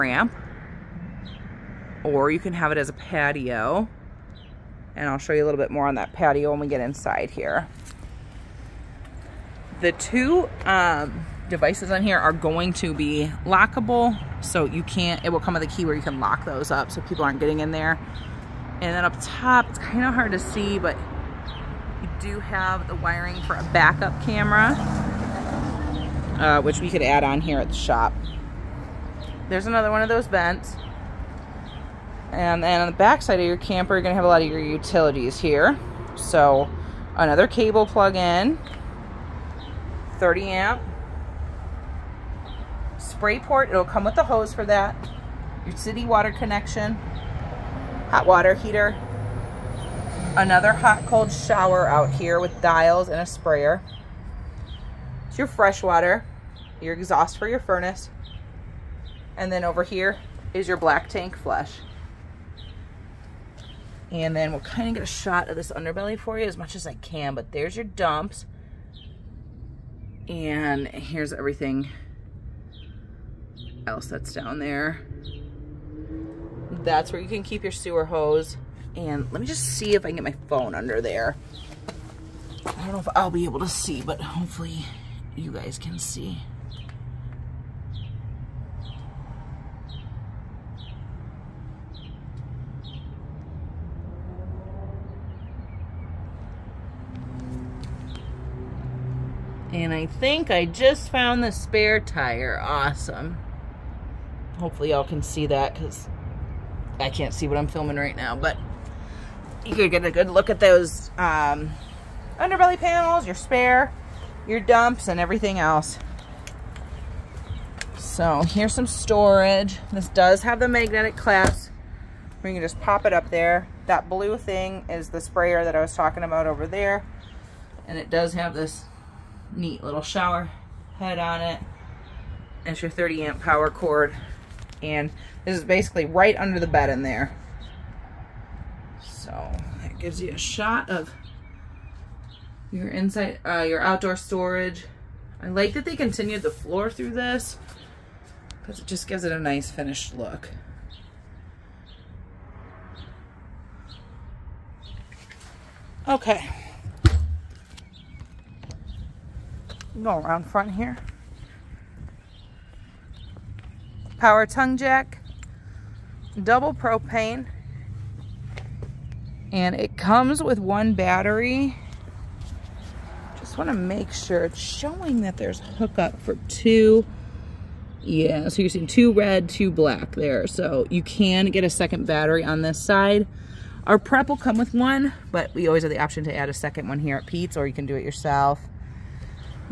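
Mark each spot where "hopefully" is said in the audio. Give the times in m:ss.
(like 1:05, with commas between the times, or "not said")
1:24, 1:44.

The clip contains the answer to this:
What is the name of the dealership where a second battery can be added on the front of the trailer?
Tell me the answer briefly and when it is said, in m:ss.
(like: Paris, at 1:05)
Pete's, at 3:07.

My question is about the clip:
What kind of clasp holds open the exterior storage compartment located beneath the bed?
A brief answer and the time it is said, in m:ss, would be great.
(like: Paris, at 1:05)
Magnetic, at 2:00.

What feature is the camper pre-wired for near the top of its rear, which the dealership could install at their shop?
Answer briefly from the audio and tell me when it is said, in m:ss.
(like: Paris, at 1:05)
Backup camera, at 0:23.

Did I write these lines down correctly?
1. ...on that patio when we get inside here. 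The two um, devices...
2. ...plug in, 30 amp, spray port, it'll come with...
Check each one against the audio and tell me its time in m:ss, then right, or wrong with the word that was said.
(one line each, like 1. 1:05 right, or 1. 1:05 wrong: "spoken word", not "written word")
1. 0:05 right
2. 0:37 right.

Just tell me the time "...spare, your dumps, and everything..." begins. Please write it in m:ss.
1:53.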